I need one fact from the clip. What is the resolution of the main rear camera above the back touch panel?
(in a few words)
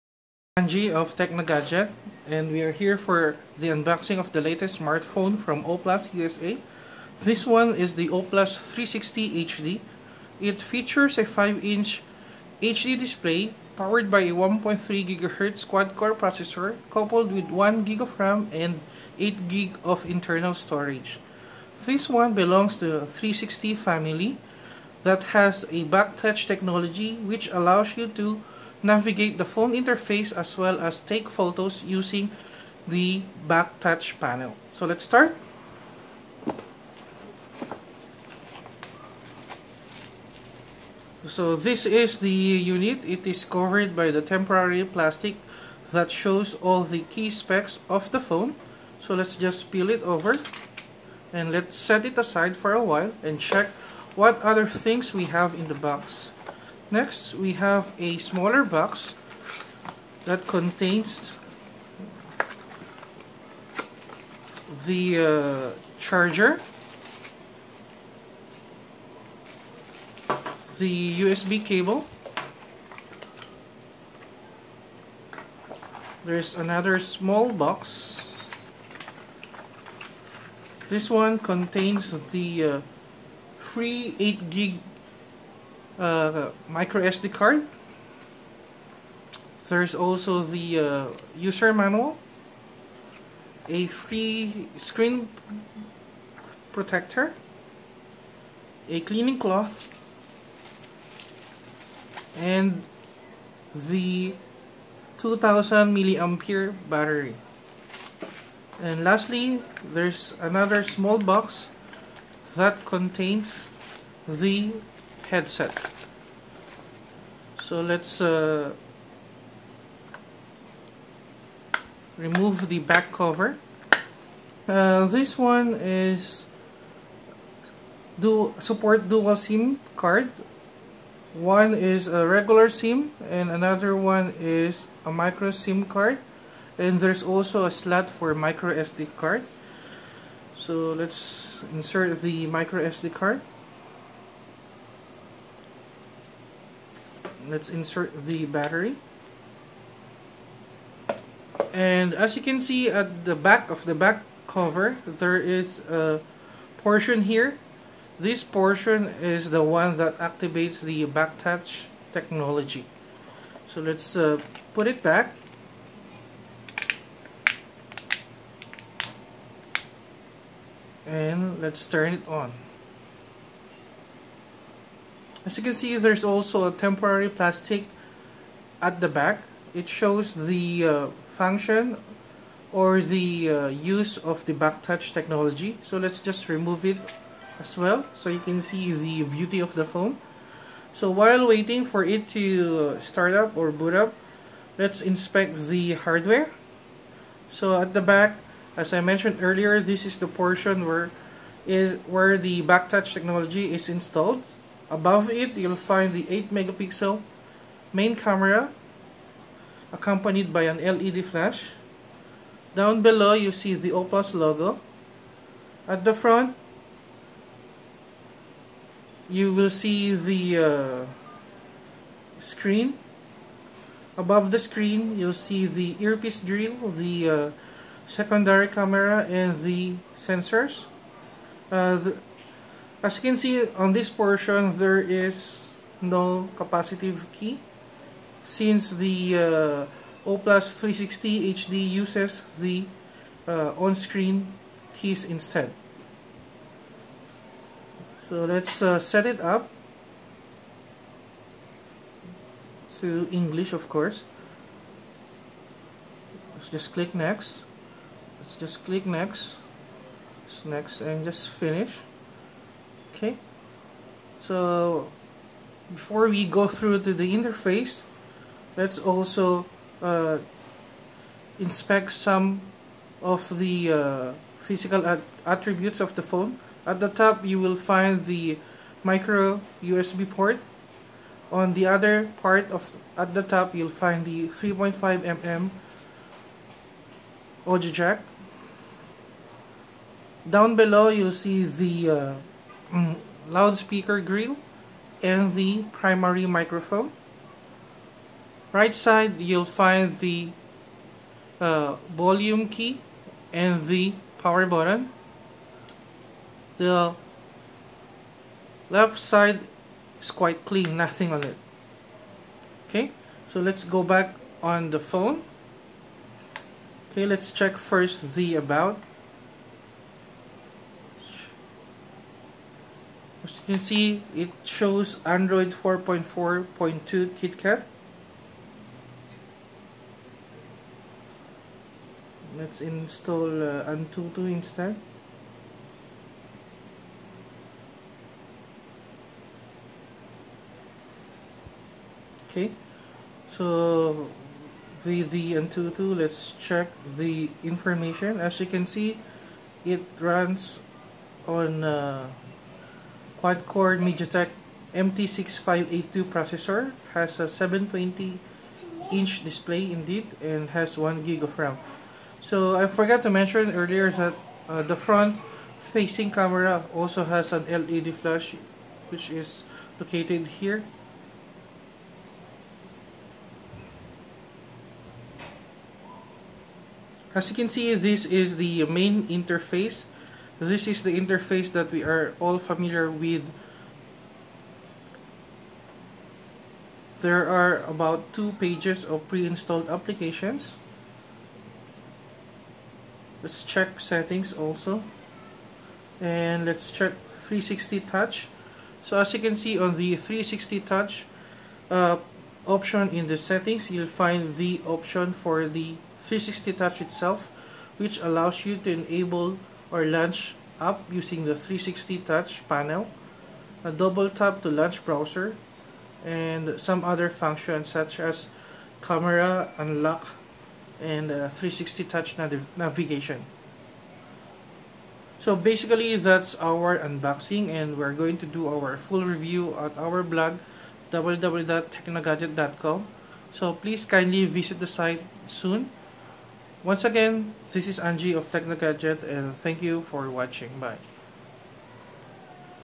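8 megapixel.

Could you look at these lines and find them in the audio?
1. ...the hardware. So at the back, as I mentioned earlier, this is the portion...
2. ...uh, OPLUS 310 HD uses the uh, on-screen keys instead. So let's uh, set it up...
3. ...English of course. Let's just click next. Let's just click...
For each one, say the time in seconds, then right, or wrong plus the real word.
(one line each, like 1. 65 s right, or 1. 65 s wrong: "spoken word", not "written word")
1. 195 s right
2. 240 s wrong: "360", not "310"
3. 253 s right.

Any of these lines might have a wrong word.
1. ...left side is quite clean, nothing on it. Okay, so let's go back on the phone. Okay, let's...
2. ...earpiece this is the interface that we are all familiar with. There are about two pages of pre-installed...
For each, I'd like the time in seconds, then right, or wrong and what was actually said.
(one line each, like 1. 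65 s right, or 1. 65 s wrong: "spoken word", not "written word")
1. 308 s right
2. 379 s wrong: "interface", not "earpiece".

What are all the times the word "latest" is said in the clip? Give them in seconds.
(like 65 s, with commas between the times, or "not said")
4 s.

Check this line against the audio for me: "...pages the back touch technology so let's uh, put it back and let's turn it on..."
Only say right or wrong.
wrong.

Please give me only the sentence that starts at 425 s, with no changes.
So basically that's our unboxing and we're going to do our full review at our blog www.teknogadyet.com.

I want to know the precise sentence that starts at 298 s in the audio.
Right side you'll find the uh, volume key and the power button.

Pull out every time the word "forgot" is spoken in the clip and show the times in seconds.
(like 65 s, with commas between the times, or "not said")
362 s.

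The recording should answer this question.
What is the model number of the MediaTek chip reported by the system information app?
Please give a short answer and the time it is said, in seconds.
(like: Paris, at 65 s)
MT6582, at 354 s.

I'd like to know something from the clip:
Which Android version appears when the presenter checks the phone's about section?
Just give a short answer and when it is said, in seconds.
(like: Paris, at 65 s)
Android 4.4.2 KitKat, at 325 s.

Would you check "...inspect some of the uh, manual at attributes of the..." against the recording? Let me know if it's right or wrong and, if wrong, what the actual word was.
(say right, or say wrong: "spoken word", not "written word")
wrong: "physical", not "manual".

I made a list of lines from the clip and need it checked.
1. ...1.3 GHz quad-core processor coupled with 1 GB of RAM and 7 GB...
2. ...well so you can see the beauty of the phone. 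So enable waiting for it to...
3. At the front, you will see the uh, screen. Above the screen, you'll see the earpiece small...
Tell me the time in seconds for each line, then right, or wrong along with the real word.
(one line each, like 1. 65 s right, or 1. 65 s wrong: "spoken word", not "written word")
1. 14 s wrong: "8", not "7"
2. 187 s wrong: "while", not "enable"
3. 215 s wrong: "grill", not "small".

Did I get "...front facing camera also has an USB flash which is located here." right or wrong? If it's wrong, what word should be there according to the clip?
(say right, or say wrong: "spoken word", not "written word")
wrong: "LED", not "USB".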